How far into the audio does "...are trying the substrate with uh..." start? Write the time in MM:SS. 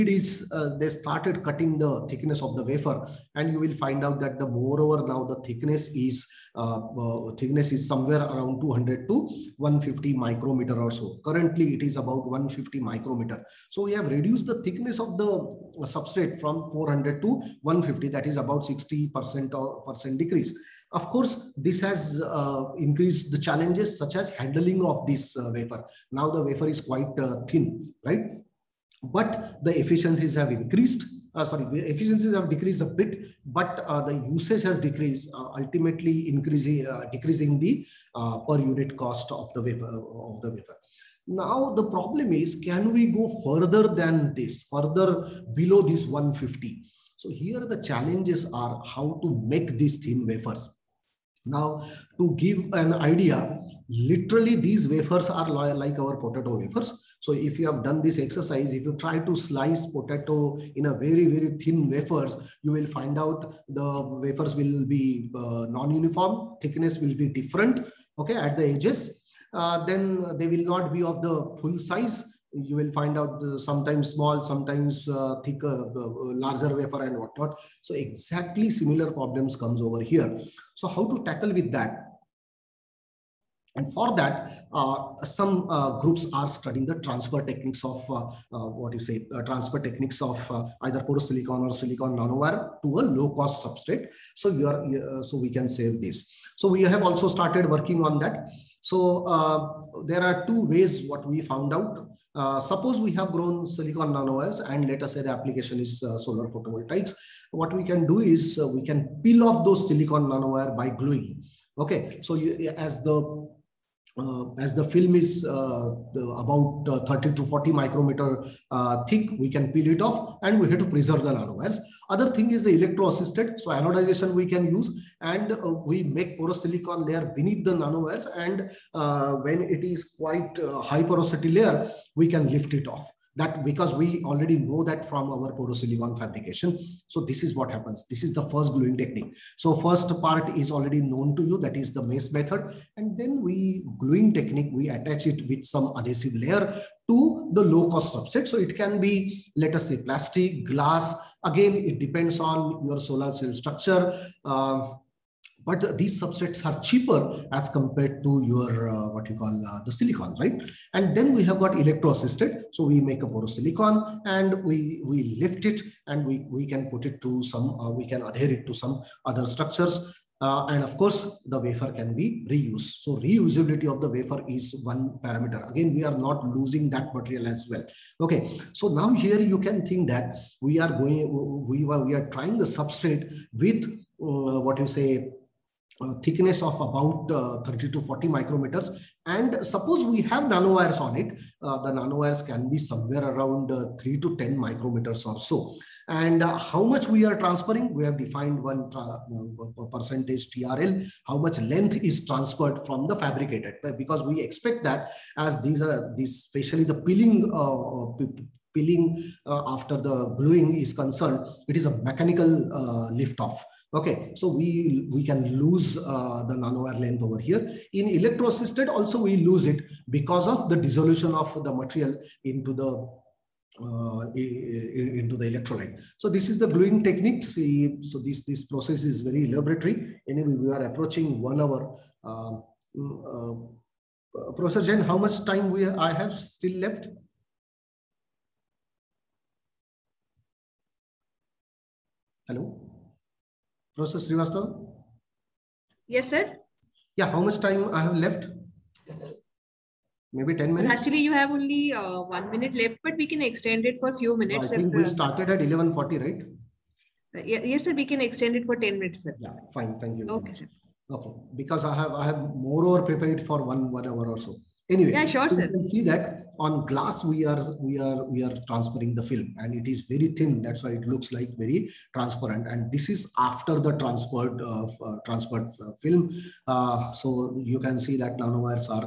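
03:02.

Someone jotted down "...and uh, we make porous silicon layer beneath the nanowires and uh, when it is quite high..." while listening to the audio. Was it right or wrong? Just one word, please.
right.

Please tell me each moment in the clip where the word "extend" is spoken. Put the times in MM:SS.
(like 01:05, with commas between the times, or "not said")
04:13, 04:18.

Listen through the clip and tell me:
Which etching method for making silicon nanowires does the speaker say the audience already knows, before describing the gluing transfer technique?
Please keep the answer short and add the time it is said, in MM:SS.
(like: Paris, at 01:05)
MACE, at 02:22.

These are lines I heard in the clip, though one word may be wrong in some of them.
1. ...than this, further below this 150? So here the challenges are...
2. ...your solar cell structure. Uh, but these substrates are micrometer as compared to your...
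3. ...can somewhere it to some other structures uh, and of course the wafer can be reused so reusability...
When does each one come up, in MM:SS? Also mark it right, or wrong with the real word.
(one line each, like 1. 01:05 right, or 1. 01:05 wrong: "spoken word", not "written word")
1. 00:43 right
2. 02:32 wrong: "cheaper", not "micrometer"
3. 02:48 wrong: "adhere", not "somewhere".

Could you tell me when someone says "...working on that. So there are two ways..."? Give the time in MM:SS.
01:37.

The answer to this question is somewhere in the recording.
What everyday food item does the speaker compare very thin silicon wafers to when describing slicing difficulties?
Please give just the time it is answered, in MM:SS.
00:56.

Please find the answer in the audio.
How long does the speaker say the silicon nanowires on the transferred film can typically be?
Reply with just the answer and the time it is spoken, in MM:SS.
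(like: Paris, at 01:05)
3 to 10 micrometers, at 03:14.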